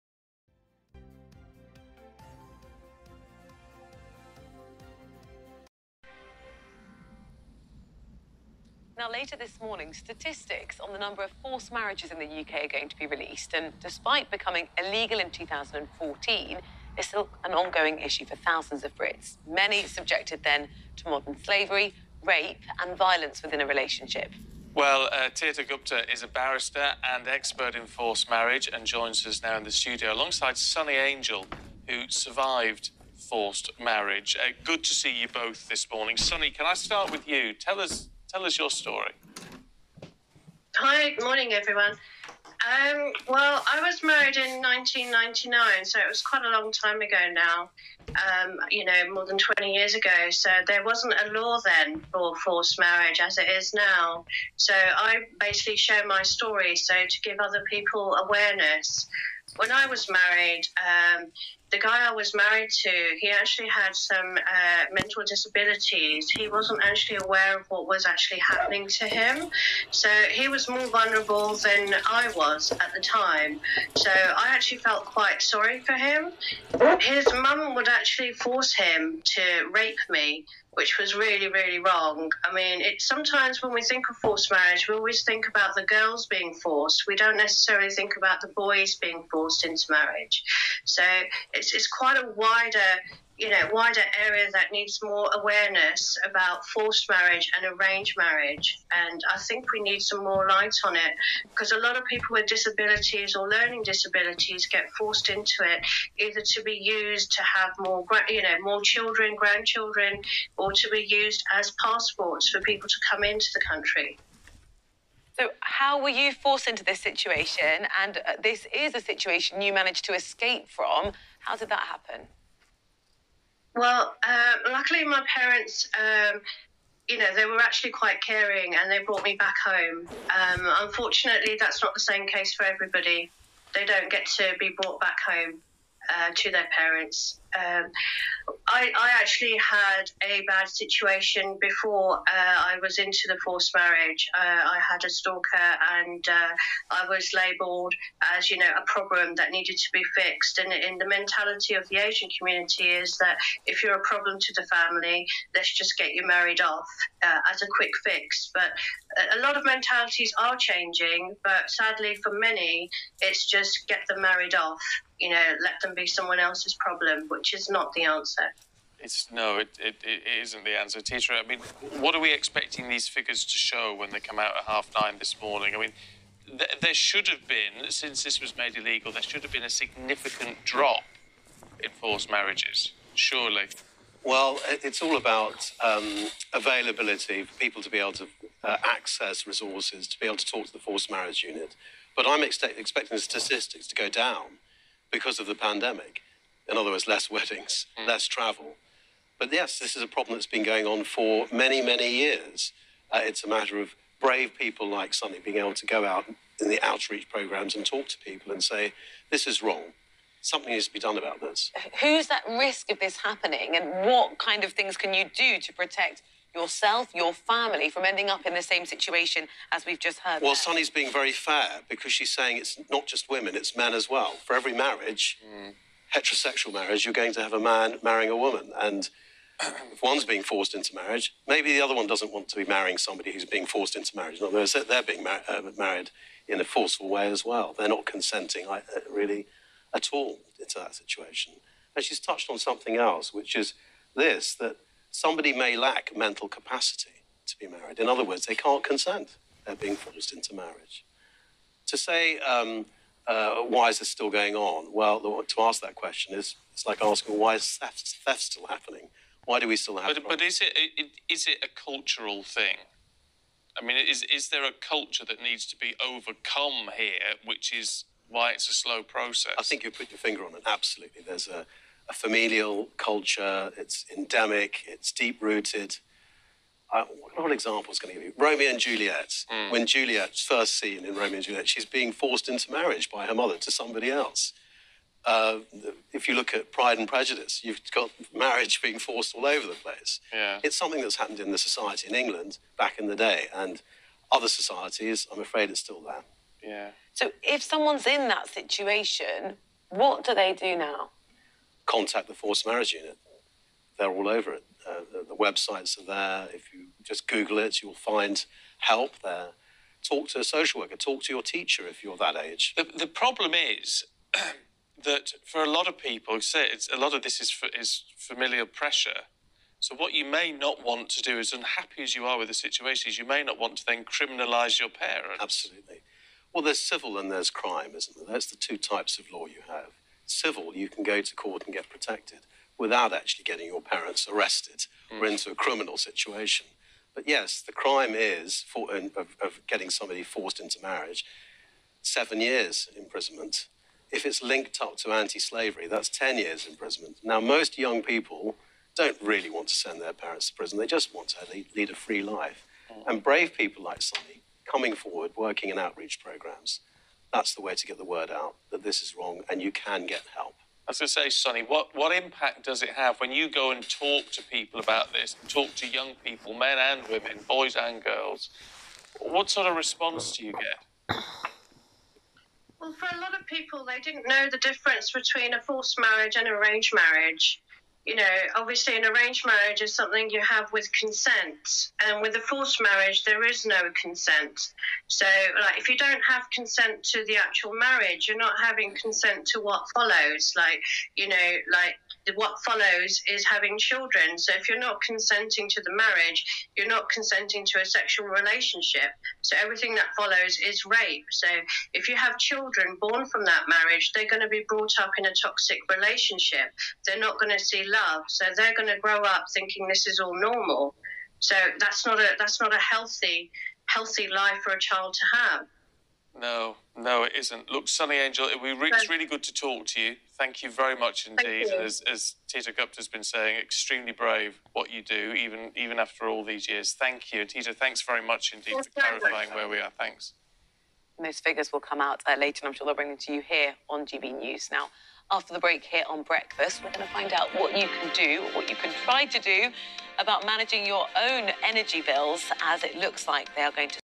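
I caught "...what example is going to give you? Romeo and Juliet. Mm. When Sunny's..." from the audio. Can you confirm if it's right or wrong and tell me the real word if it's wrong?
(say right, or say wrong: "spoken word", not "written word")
wrong: "Juliet", not "Sunny".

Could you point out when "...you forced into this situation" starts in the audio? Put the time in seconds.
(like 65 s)
116 s.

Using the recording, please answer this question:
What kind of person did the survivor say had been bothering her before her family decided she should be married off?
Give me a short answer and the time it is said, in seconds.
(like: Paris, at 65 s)
A stalker, at 145 s.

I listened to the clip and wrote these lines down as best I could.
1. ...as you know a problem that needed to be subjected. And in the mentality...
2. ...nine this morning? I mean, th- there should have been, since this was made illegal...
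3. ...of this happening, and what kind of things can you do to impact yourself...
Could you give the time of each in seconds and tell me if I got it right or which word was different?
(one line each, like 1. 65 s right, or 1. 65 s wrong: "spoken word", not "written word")
1. 148 s wrong: "fixed", not "subjected"
2. 174 s right
3. 212 s wrong: "protect", not "impact".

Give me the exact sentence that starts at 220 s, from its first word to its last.
Well, Sunny's being very fair because she's saying it's not just women, it's men as well.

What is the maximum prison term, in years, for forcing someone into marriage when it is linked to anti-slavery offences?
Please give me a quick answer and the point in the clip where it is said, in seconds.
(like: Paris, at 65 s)
10 years, at 346 s.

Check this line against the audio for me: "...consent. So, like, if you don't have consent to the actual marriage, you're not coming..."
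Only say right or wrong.
wrong.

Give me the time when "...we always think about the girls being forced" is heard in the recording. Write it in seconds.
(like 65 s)
84 s.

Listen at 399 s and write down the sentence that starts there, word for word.
So, everything that follows is rape.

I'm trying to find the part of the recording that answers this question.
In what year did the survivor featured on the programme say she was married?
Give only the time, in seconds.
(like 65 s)
44 s.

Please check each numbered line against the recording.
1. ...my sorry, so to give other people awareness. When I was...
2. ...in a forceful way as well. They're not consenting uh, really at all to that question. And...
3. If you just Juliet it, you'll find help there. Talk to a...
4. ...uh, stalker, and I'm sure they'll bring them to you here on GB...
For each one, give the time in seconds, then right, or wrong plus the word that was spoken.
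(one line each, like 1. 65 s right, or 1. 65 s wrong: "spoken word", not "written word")
1. 56 s wrong: "story", not "sorry"
2. 236 s wrong: "situation", not "question"
3. 306 s wrong: "Google", not "Juliet"
4. 432 s wrong: "later", not "stalker".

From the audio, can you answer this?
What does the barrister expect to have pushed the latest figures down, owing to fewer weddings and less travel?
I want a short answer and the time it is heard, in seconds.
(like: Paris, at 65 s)
The pandemic, at 195 s.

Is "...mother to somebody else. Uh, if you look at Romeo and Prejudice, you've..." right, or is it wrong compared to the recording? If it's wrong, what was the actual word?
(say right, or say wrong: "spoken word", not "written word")
wrong: "Pride", not "Romeo".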